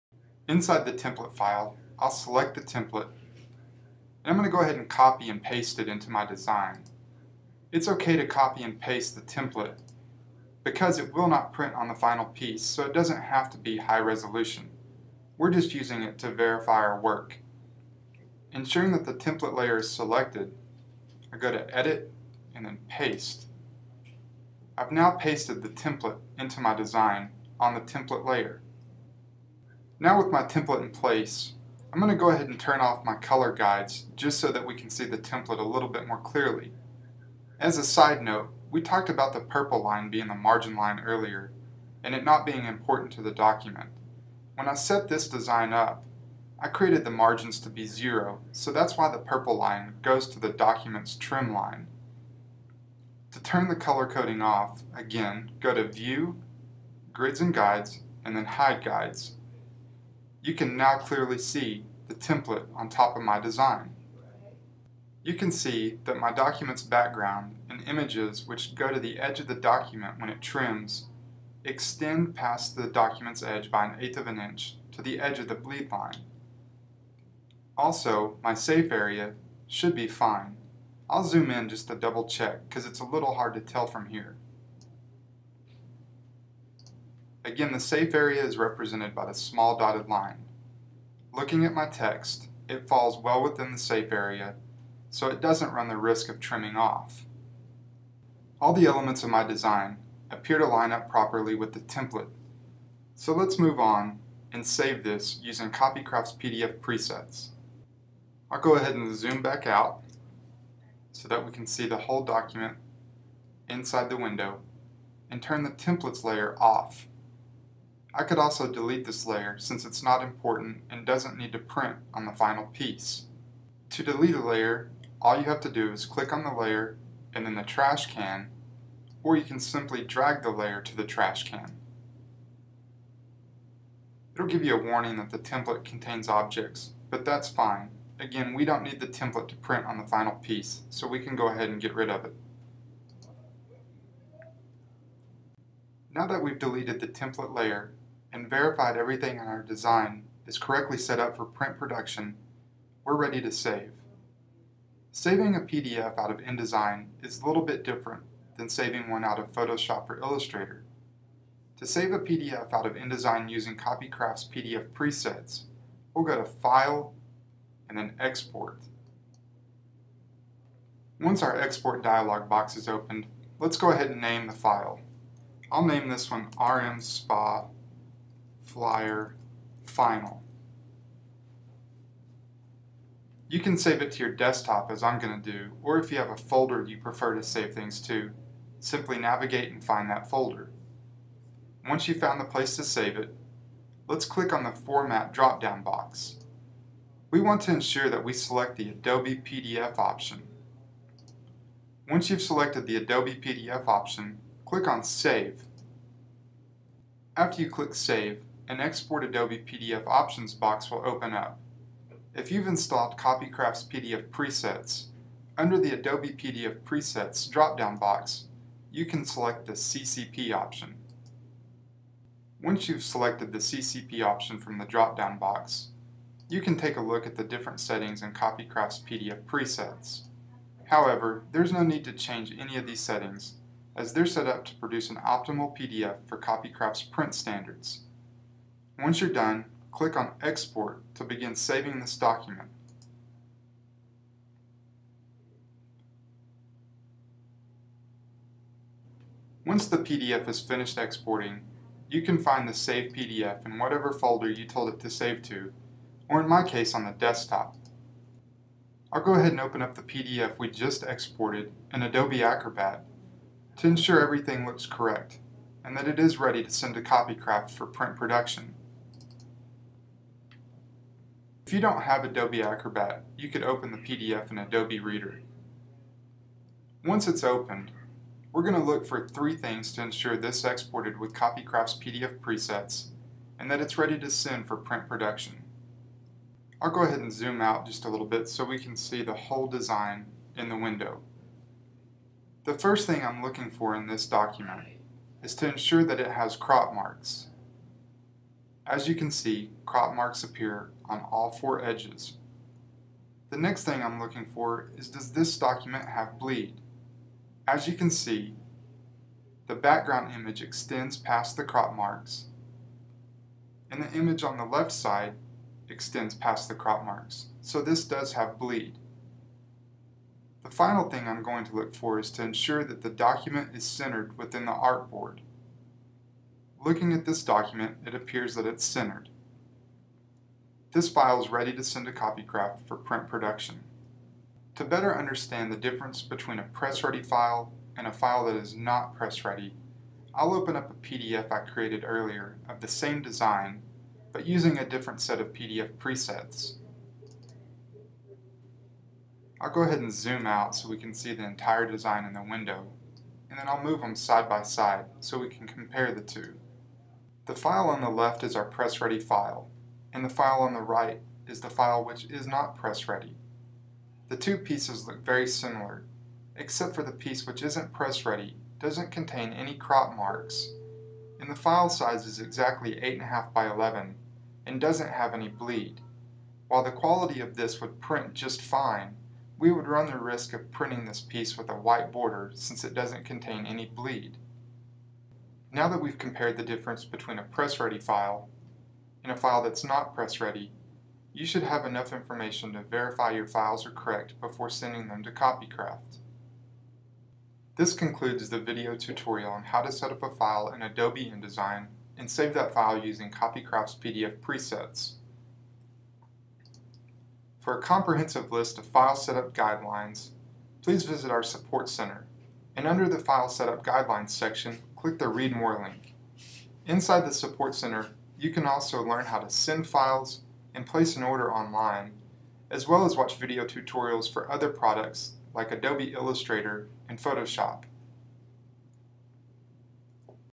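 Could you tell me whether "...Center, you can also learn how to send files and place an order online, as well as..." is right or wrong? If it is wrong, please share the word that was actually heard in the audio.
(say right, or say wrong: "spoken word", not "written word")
right.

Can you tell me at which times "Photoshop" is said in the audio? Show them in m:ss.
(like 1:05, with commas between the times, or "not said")
2:39, 7:07.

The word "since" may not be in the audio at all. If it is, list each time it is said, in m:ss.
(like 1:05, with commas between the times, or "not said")
1:59, 6:22.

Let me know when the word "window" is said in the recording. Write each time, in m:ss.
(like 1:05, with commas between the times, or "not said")
1:54, 4:50, 5:52.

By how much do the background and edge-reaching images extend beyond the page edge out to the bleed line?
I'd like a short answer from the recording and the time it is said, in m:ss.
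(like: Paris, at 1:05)
an eighth of an inch, at 1:13.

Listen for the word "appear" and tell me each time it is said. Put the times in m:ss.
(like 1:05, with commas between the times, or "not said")
1:40, 5:00, 5:28.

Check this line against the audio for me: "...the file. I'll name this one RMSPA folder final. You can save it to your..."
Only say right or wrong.
wrong.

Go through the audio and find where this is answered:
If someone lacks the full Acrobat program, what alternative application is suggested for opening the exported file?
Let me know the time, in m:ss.
4:34.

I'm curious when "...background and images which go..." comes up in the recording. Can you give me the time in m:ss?
1:06.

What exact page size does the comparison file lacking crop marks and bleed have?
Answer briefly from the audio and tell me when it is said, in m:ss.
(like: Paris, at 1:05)
8.5 by 11, at 6:12.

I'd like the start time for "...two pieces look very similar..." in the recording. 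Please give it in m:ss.
6:04.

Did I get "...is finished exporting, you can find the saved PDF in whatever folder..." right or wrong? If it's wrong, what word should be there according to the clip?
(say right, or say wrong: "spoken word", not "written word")
right.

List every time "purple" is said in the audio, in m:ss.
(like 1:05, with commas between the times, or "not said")
0:39, 0:49.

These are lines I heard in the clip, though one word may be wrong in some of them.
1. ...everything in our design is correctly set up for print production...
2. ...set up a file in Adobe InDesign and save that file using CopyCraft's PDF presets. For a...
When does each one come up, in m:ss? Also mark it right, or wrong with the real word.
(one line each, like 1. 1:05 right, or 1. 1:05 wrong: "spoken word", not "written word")
1. 2:28 right
2. 6:39 right.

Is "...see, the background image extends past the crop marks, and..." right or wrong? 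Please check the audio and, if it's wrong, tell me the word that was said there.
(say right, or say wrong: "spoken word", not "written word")
right.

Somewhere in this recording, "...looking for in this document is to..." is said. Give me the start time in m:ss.
4:53.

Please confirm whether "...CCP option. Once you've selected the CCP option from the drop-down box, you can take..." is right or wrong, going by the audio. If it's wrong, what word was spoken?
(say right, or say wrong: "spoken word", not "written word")
right.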